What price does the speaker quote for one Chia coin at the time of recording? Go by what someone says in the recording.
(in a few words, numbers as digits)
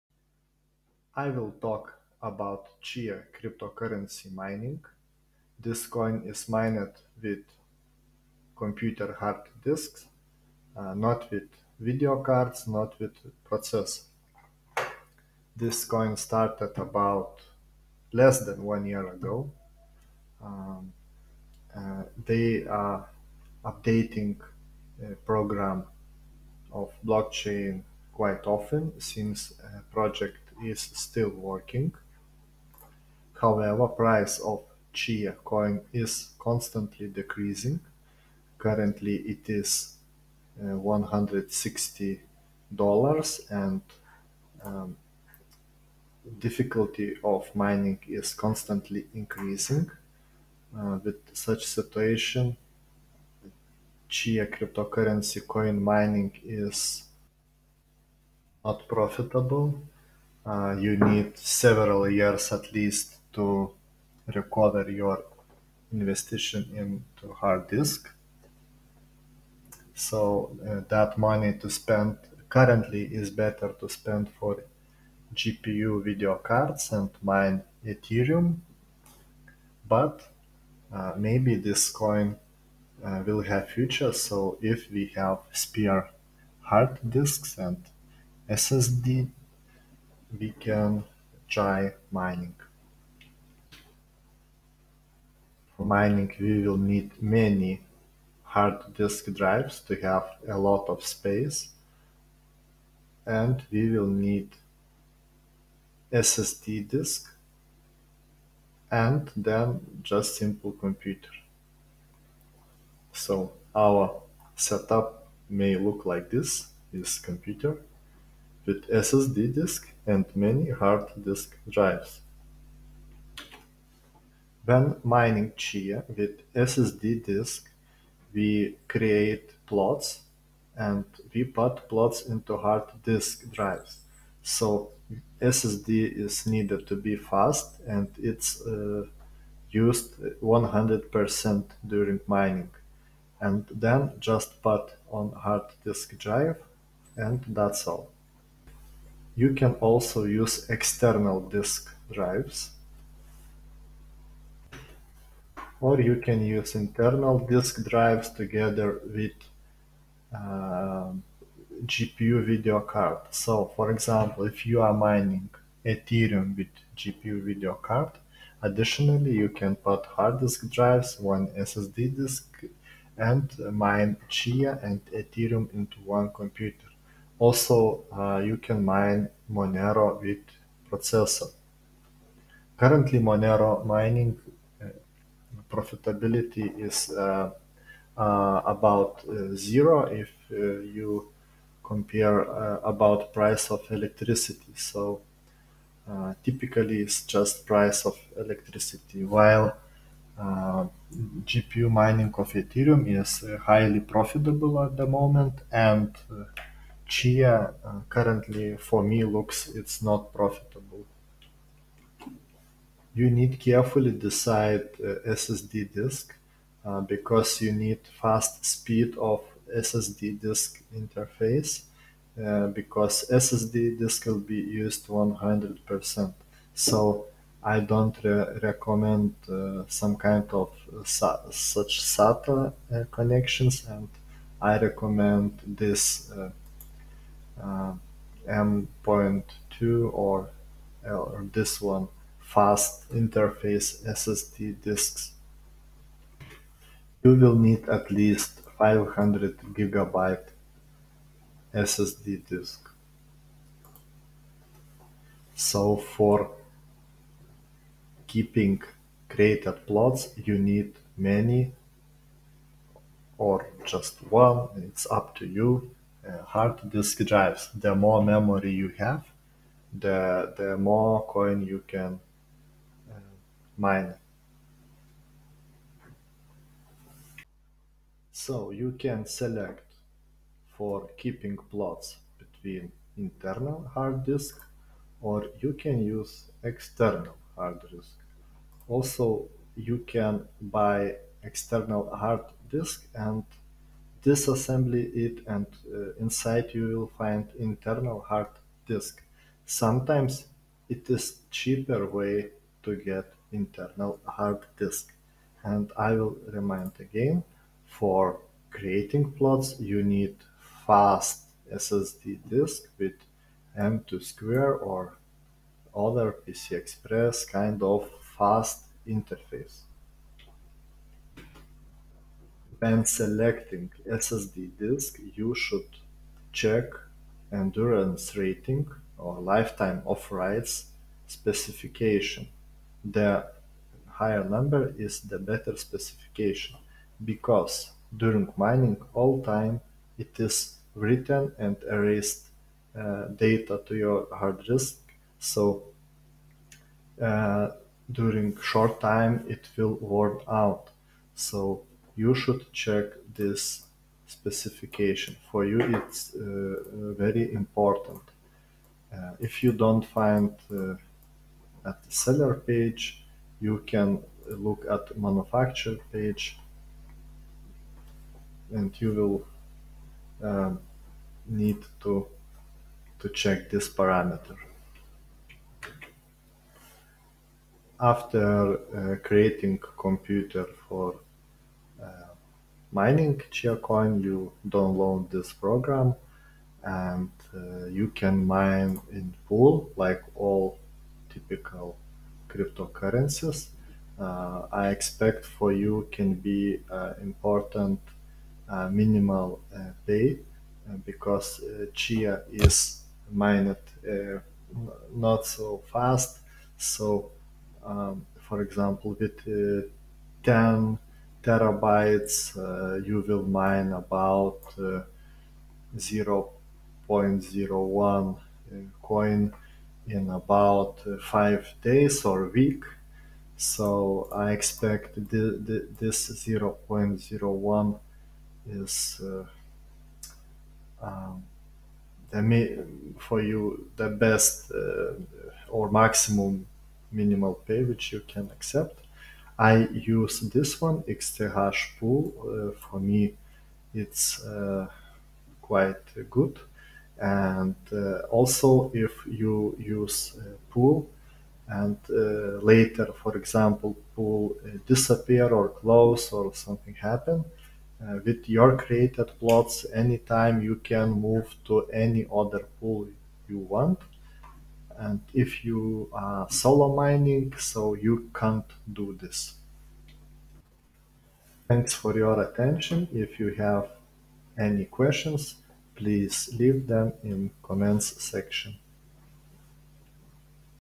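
$160.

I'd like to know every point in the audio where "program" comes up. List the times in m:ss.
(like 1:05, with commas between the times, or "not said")
0:25, 6:25.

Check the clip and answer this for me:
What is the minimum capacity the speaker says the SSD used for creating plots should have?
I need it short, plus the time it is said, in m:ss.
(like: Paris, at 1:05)
500 gigabytes, at 4:08.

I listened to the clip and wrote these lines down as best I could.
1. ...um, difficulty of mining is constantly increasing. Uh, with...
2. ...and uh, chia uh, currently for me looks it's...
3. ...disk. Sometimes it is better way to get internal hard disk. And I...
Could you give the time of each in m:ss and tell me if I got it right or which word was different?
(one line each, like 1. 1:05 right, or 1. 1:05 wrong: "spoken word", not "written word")
1. 0:44 right
2. 3:25 right
3. 4:58 wrong: "cheaper", not "better".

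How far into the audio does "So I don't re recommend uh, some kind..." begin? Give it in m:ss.
3:46.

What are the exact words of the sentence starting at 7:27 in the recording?
And uh, also, if you use Pool, and uh, later, for example, pool uh, disappear or close or something happen.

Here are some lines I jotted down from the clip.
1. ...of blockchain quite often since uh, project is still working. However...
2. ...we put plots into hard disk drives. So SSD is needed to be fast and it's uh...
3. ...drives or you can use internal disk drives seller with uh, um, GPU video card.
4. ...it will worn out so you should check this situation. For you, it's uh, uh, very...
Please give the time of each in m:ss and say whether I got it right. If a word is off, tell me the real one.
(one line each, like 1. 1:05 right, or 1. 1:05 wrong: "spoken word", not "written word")
1. 0:26 right
2. 2:11 right
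3. 2:32 wrong: "together", not "seller"
4. 5:49 wrong: "specification", not "situation".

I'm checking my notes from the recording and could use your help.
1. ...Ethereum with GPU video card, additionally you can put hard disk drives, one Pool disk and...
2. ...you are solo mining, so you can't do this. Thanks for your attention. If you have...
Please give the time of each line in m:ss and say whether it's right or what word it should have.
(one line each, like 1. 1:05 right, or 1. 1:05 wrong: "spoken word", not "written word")
1. 2:45 wrong: "SSD", not "Pool"
2. 7:45 right.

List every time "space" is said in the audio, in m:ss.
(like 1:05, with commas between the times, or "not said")
1:41.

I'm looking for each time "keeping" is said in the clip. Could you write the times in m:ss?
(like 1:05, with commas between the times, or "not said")
4:18, 4:41.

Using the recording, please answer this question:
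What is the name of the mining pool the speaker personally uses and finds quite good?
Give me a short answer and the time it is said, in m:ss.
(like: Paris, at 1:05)
Xterash Pool, at 7:21.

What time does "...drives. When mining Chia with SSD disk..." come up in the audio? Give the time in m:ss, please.
2:01.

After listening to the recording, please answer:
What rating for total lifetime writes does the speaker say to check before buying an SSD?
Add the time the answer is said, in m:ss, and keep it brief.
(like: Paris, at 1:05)
endurance rating, at 5:27.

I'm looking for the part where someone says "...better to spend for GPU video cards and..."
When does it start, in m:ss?
1:13.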